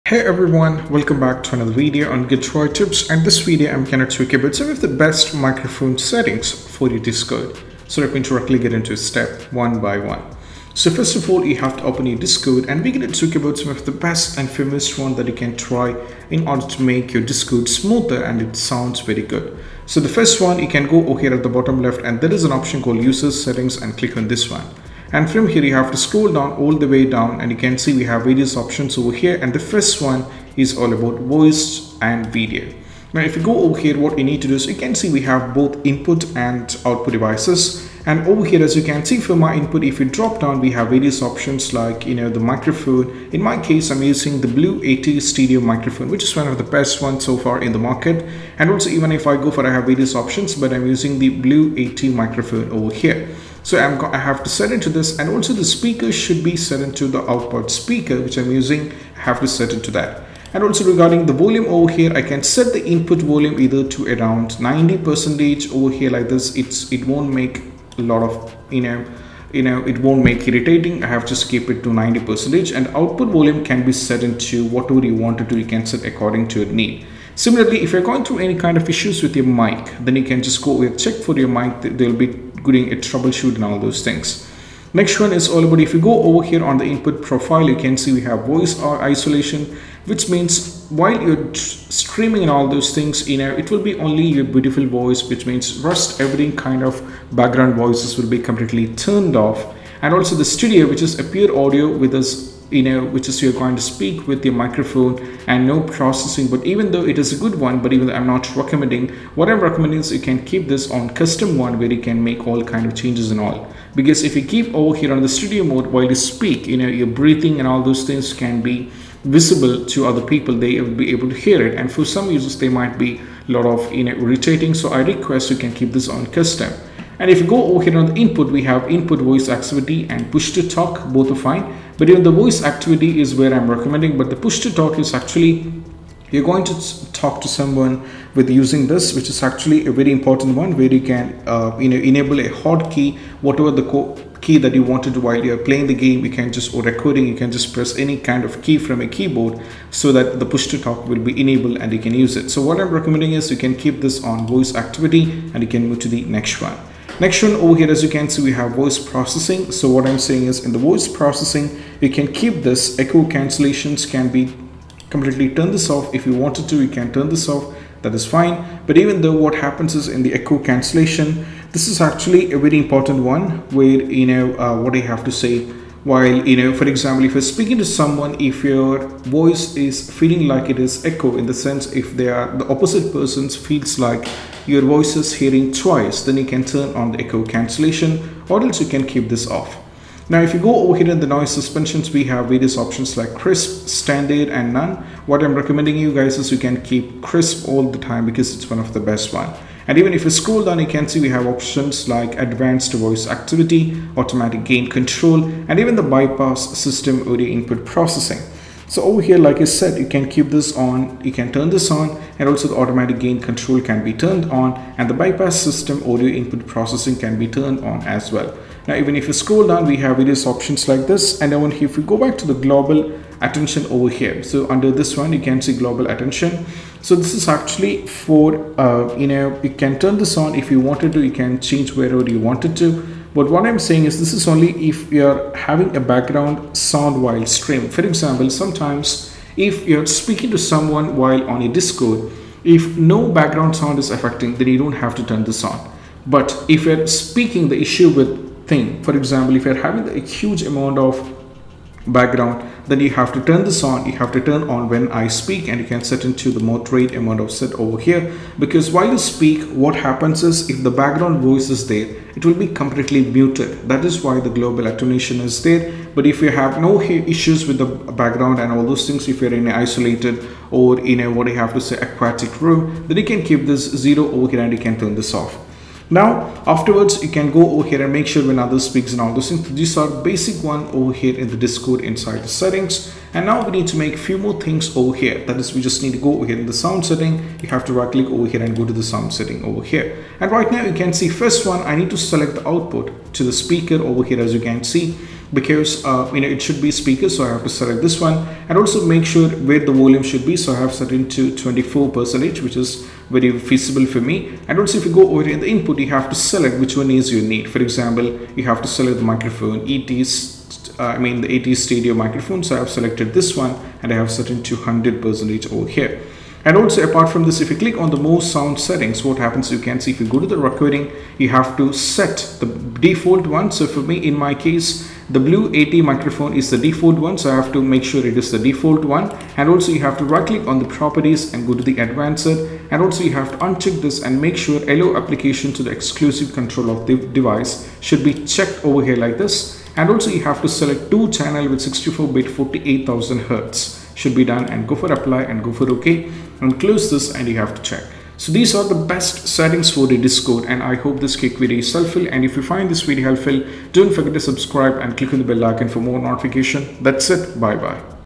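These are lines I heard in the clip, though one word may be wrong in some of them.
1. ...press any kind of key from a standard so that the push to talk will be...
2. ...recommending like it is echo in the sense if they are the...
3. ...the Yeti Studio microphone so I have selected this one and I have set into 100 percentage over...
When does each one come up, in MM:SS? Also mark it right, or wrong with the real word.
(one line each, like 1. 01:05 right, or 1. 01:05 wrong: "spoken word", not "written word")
1. 02:27 wrong: "keyboard", not "standard"
2. 03:00 wrong: "feeling", not "recommending"
3. 05:11 right.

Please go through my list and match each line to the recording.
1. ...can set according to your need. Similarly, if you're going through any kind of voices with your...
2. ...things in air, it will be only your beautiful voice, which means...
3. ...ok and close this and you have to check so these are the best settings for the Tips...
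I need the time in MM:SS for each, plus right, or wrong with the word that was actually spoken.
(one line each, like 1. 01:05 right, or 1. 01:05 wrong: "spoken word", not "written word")
1. 01:15 wrong: "issues", not "voices"
2. 01:32 right
3. 05:45 wrong: "Discord", not "Tips".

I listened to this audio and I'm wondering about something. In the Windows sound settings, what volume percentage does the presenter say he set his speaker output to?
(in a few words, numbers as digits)
24.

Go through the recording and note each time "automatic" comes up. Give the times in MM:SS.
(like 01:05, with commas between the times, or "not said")
03:24, 03:32.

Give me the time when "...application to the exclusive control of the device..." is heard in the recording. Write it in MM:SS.
05:35.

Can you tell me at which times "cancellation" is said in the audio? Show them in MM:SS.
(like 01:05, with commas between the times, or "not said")
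02:43, 02:50, 03:07.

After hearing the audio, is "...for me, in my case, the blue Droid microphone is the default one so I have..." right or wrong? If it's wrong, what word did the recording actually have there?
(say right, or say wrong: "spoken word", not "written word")
wrong: "Yeti", not "Droid".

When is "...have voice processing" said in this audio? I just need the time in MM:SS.
02:38.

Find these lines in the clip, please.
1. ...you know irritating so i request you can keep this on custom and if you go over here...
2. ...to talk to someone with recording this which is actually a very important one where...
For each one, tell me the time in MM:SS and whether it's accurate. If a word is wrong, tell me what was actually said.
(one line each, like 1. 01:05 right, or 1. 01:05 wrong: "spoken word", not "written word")
1. 02:03 right
2. 02:16 wrong: "using", not "recording".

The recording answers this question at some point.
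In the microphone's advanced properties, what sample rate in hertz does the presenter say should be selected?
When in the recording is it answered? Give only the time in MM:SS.
05:42.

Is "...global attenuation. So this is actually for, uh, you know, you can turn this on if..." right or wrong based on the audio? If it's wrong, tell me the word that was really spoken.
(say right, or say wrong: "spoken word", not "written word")
right.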